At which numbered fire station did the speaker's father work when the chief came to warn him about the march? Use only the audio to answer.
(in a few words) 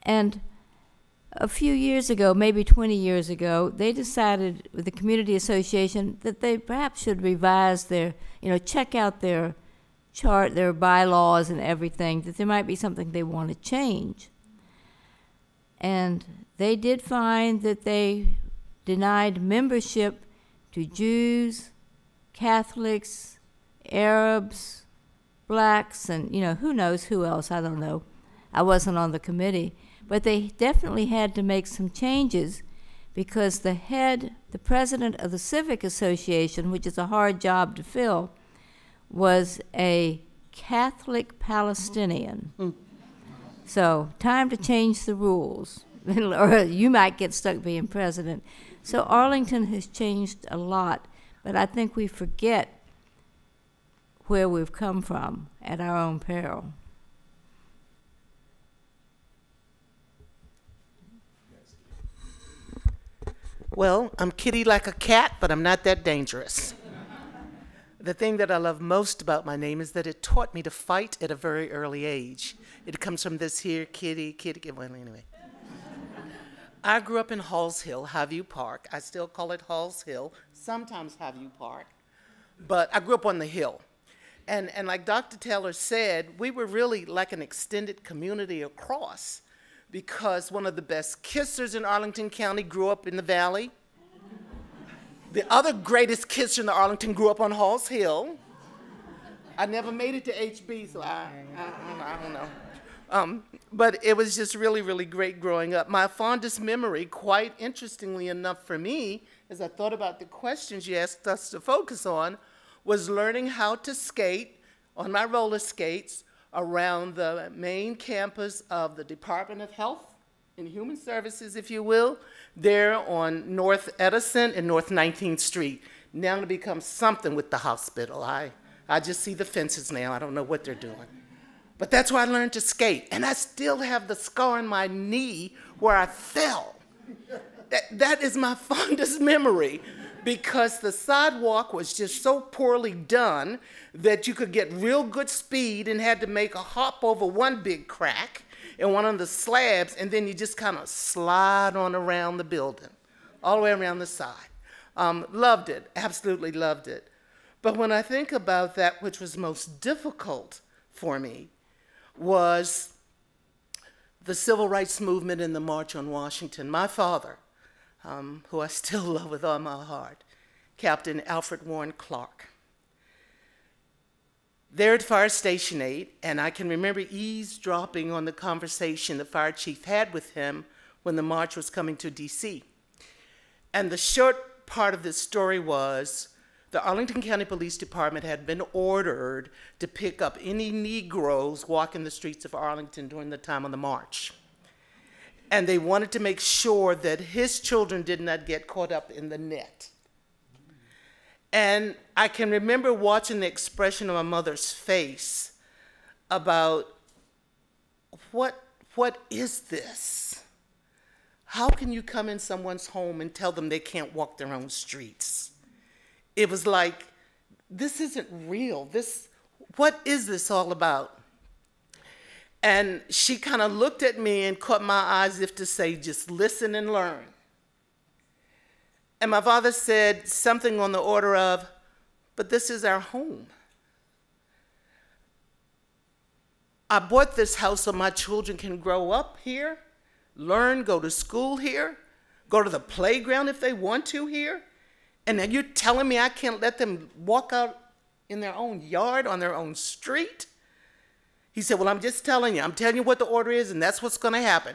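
Fire Station 8.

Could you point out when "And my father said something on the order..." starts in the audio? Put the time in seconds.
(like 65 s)
229 s.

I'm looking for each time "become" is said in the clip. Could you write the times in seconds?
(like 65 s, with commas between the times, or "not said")
126 s.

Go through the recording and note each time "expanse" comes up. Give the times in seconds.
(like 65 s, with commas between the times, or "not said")
not said.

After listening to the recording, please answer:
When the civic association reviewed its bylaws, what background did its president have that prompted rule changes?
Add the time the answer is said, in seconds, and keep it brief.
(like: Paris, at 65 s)
Catholic Palestinian, at 40 s.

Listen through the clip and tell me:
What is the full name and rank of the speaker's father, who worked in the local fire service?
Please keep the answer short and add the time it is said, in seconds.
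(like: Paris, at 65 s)
Captain Alfred Warren Clark, at 170 s.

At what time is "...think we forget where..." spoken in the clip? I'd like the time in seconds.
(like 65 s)
51 s.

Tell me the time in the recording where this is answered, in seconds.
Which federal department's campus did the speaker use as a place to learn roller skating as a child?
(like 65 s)
119 s.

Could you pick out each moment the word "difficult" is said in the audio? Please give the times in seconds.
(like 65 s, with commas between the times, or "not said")
159 s.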